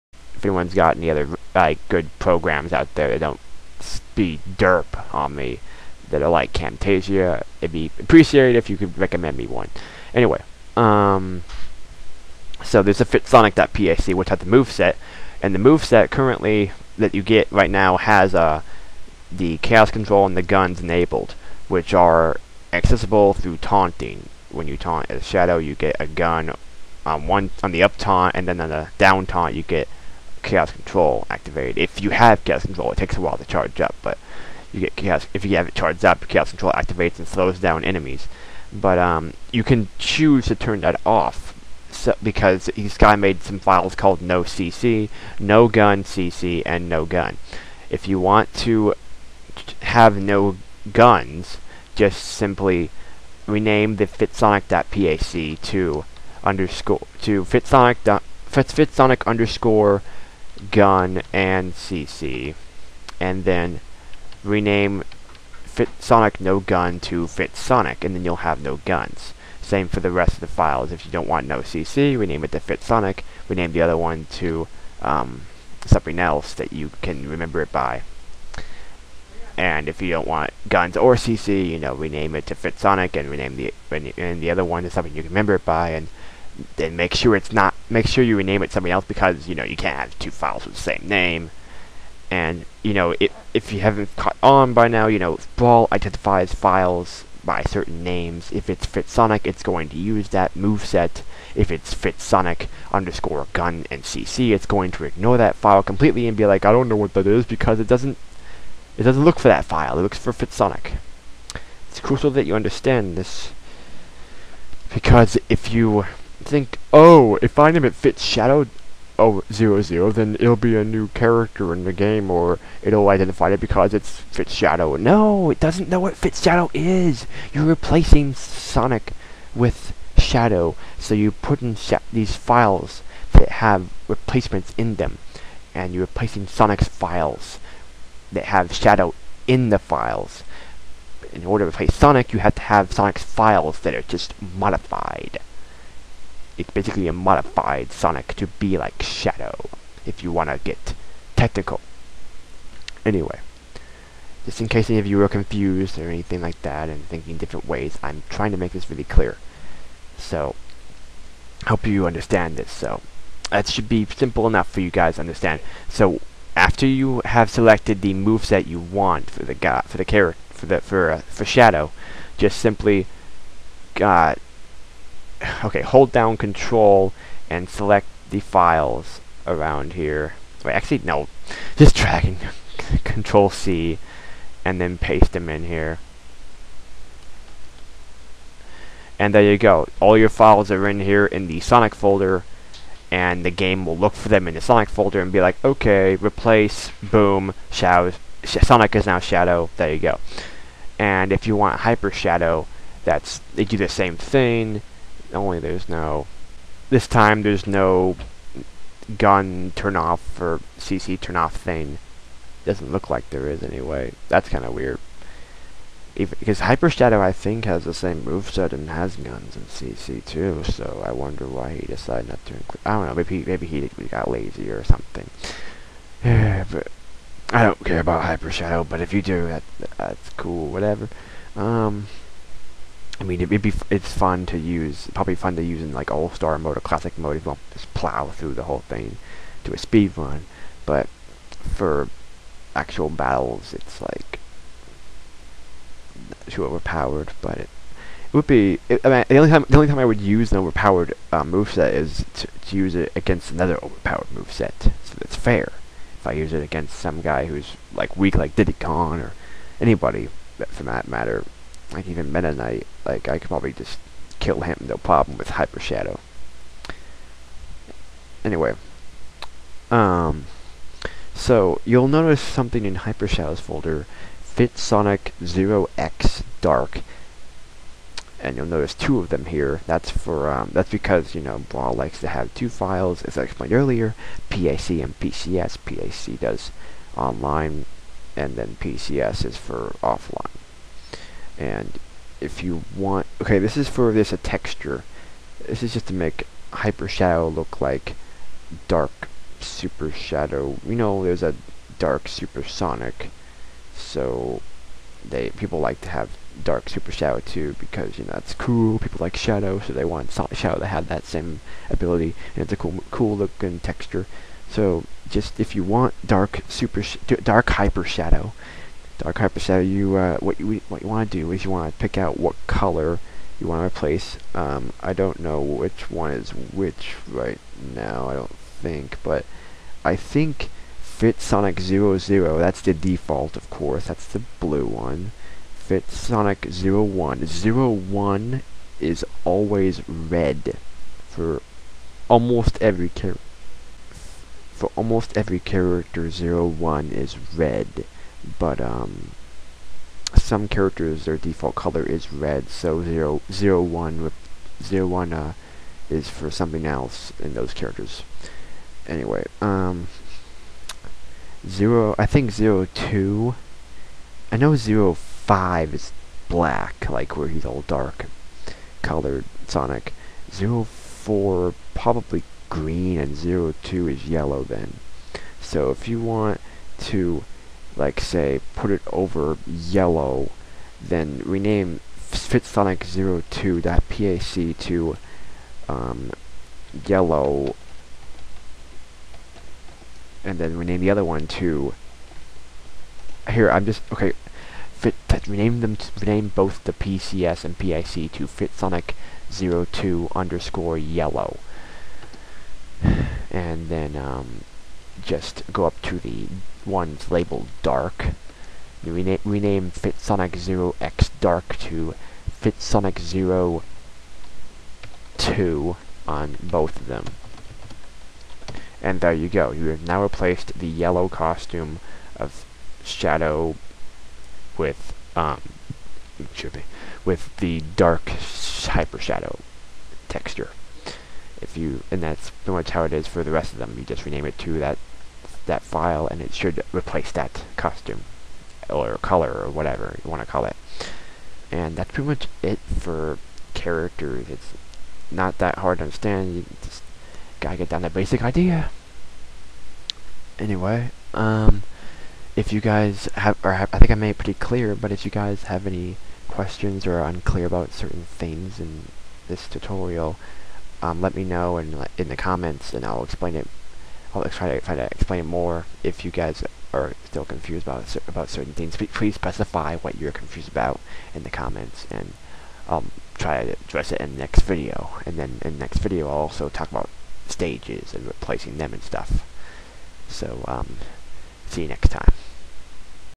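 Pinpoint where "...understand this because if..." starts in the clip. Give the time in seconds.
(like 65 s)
112 s.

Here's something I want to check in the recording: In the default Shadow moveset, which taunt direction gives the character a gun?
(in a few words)
up taunt.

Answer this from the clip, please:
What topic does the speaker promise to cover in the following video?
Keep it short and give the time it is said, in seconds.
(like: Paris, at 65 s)
stages, at 477 s.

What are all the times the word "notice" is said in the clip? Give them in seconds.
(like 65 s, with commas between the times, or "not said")
272 s, 278 s.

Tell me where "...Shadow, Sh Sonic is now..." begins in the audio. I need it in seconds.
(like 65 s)
197 s.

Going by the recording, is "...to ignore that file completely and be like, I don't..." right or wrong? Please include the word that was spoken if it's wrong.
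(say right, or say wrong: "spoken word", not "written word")
right.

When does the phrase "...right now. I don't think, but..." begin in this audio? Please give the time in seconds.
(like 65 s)
327 s.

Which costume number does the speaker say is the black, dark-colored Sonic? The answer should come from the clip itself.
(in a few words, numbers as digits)
05.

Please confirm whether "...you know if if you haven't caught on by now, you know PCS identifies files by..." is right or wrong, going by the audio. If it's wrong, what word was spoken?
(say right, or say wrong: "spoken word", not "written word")
wrong: "Brawl", not "PCS".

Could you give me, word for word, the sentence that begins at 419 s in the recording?
You have now replaced the yellow costume of Shadow with, um, excuse me, with the dark hyper shadow texture.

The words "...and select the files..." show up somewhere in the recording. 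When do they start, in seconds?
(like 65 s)
177 s.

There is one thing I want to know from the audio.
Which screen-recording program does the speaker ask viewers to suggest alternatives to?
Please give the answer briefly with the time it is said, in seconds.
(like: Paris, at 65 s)
Camtasia, at 6 s.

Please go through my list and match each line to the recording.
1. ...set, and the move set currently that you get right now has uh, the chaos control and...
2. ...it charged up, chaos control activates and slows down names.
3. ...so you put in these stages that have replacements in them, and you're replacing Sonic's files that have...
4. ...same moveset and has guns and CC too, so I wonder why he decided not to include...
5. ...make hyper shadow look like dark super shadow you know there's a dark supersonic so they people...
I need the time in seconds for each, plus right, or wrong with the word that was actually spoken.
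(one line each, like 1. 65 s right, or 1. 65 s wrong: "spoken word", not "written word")
1. 14 s right
2. 35 s wrong: "enemies", not "names"
3. 130 s wrong: "files", not "stages"
4. 217 s right
5. 296 s right.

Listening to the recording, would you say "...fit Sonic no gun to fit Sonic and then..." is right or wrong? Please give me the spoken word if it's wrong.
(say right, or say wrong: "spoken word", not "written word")
right.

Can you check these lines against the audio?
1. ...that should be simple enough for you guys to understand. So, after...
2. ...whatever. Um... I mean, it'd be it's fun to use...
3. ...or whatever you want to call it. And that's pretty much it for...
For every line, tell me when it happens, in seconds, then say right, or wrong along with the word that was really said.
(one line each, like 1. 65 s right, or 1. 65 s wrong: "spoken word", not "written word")
1. 163 s right
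2. 230 s right
3. 439 s right.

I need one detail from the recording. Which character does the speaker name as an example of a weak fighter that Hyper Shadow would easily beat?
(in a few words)
Diddy Kong.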